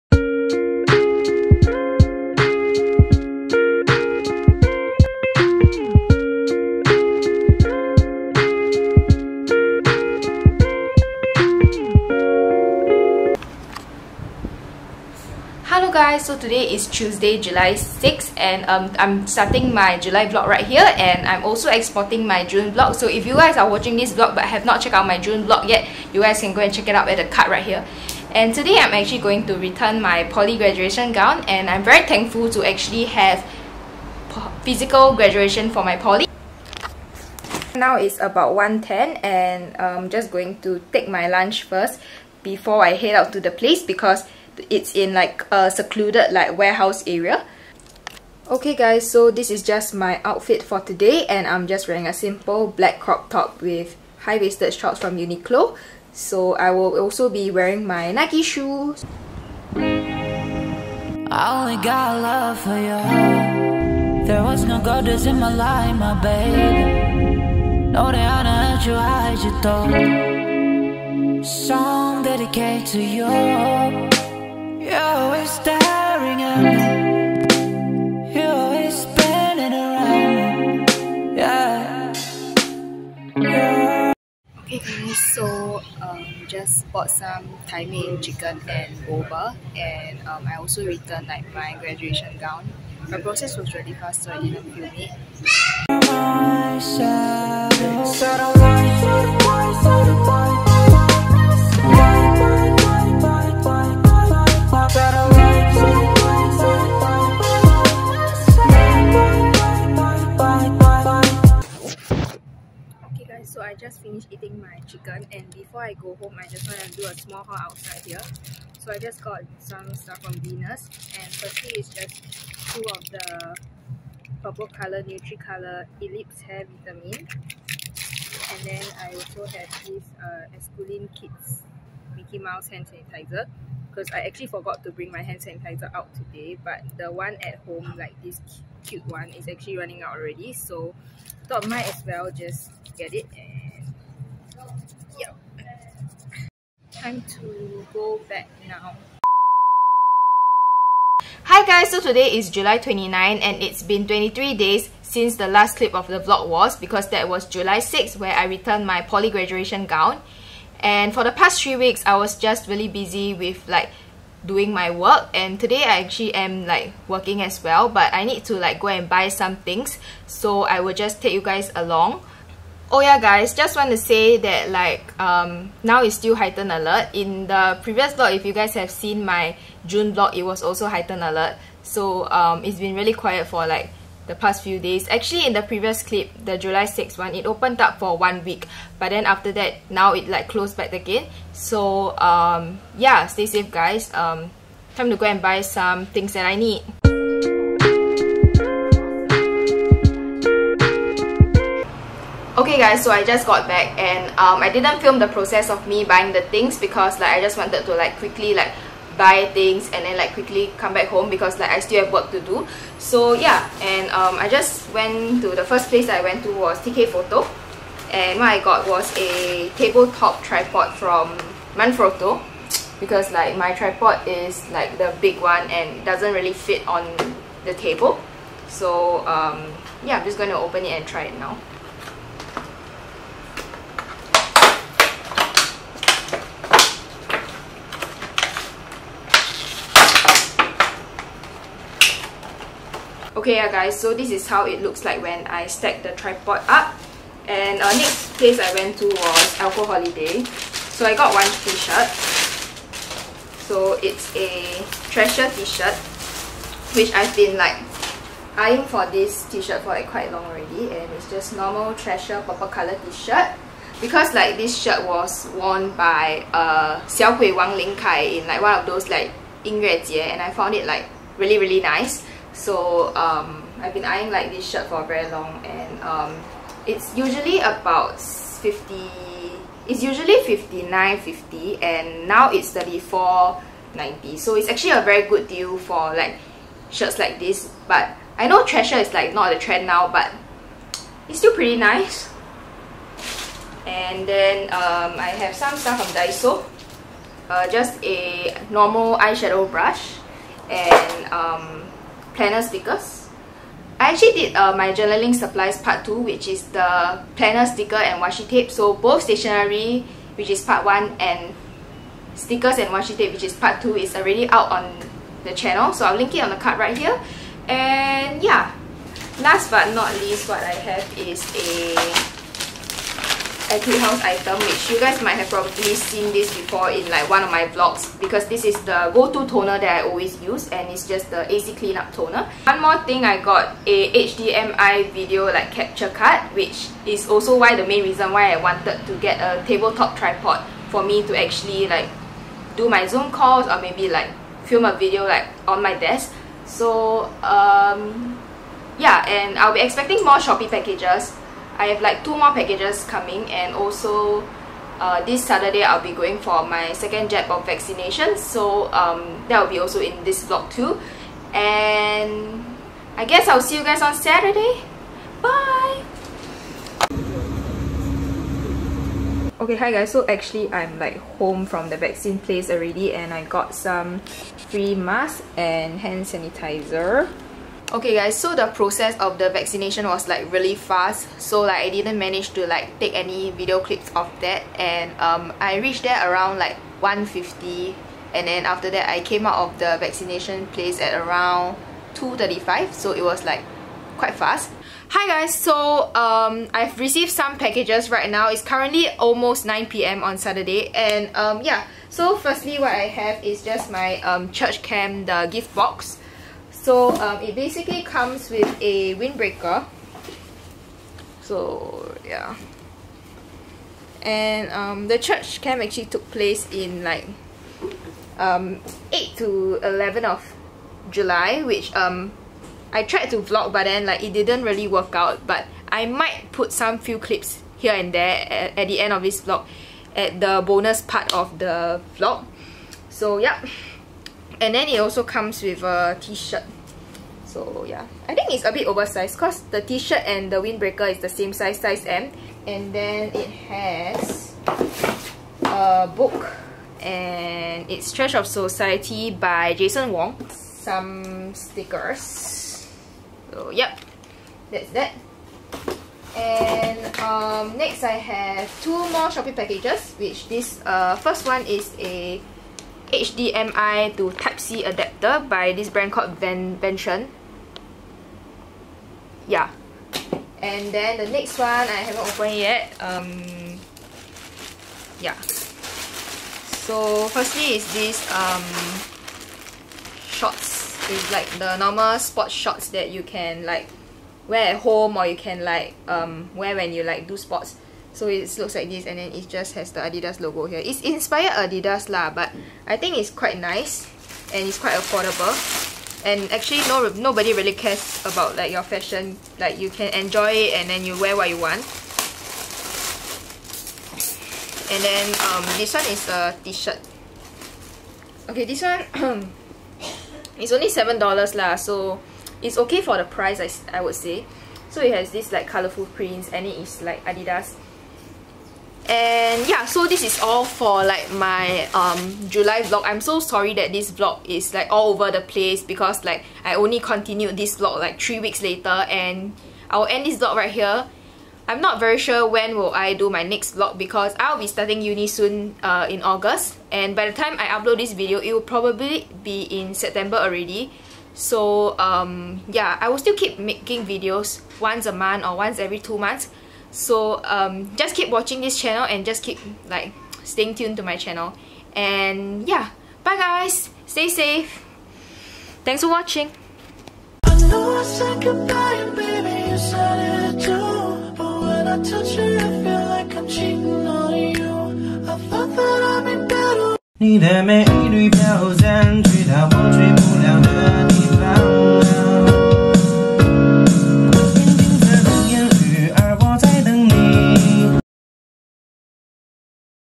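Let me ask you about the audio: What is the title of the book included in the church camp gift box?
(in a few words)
Trash of Society.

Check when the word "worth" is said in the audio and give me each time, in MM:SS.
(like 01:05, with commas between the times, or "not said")
not said.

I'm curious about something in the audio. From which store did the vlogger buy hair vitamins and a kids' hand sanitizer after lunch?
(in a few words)
Venus.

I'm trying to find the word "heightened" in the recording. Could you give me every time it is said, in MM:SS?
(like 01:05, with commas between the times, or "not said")
02:56, 03:00.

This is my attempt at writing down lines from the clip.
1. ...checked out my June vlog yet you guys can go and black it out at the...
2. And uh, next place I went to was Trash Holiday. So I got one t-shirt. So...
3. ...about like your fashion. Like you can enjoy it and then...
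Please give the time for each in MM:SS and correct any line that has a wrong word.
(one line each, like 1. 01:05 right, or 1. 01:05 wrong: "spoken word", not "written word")
1. 00:24 wrong: "check", not "black"
2. 04:07 wrong: "Alco", not "Trash"
3. 08:18 right.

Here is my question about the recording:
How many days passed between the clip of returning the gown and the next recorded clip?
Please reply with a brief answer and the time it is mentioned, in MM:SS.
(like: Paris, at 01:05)
23, at 02:34.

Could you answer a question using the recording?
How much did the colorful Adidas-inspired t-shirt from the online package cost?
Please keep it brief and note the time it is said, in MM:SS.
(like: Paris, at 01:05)
$7, at 08:30.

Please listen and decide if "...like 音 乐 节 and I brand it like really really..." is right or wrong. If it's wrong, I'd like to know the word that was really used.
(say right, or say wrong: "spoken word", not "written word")
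wrong: "found", not "brand".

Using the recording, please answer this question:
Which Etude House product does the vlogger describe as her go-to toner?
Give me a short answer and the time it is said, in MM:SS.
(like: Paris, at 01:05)
AC Cleanup Toner, at 05:31.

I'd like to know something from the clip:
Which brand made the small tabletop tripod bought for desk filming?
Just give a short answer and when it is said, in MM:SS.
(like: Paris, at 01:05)
Manfrotto, at 03:41.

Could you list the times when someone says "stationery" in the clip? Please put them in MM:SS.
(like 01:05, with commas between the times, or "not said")
05:09.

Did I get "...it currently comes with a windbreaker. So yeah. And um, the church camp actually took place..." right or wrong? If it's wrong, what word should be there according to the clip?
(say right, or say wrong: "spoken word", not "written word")
wrong: "basically", not "currently".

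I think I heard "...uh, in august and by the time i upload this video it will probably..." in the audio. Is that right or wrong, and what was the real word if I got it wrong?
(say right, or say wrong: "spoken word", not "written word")
right.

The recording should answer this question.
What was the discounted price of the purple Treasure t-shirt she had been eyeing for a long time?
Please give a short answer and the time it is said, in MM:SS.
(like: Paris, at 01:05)
34.90, at 04:42.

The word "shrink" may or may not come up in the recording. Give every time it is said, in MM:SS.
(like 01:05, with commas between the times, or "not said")
not said.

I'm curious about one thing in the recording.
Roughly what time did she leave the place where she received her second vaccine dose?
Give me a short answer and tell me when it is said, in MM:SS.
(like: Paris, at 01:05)
2:35, at 06:32.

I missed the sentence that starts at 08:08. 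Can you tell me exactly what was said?
So it looks like this and then it just has the Adidas logo here.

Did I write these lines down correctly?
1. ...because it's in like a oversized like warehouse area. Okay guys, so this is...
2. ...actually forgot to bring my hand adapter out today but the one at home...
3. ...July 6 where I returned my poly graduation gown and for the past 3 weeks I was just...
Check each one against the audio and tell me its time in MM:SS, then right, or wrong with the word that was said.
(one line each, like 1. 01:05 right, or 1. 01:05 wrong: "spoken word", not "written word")
1. 00:43 wrong: "secluded", not "oversized"
2. 02:14 wrong: "sanitizer", not "adapter"
3. 02:37 right.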